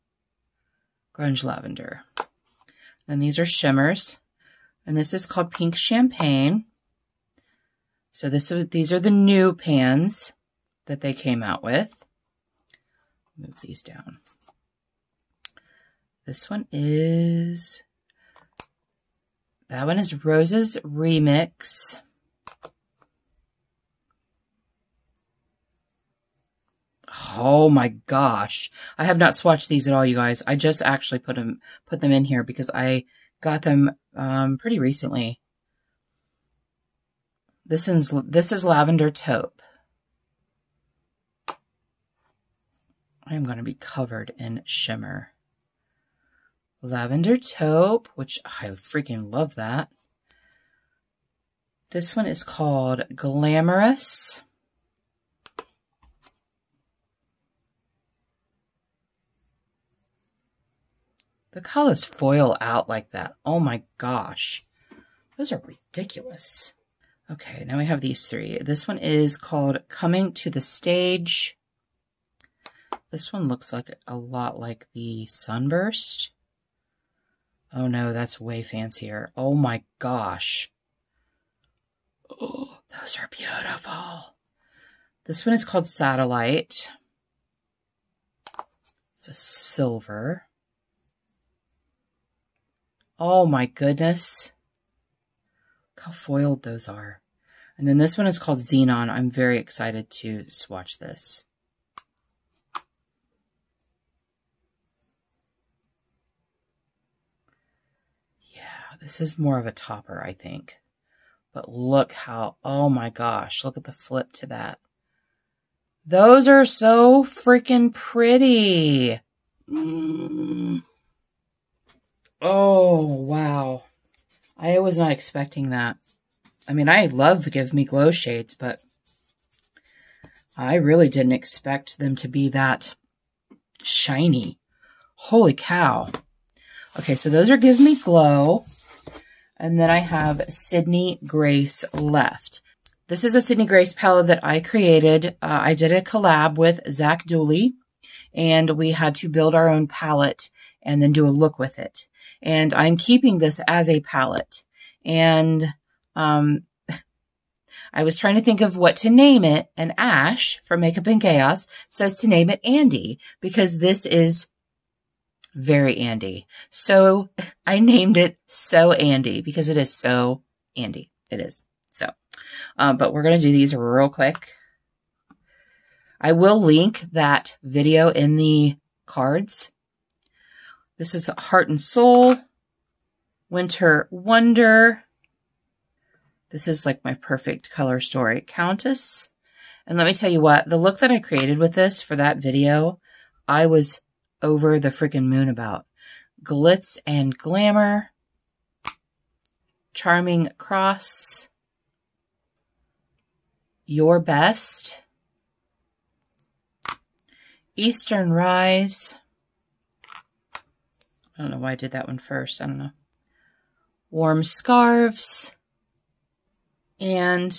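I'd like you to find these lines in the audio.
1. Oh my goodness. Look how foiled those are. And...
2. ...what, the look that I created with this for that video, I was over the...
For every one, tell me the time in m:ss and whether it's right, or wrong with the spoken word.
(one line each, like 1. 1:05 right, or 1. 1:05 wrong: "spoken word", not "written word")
1. 1:33 right
2. 3:10 right.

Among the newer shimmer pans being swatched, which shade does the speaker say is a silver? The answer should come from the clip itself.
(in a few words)
Satellite.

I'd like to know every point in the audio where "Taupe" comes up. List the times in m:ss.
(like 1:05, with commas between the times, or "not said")
0:39, 0:47.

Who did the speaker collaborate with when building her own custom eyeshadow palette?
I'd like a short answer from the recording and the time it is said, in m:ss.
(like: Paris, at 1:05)
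Zee Dooley, at 2:26.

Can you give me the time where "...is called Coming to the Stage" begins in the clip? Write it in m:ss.
1:08.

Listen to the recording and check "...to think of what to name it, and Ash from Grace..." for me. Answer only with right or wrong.
wrong.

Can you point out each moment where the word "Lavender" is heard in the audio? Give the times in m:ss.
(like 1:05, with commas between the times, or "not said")
0:01, 0:38, 0:46.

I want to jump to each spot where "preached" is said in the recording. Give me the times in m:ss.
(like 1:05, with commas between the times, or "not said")
not said.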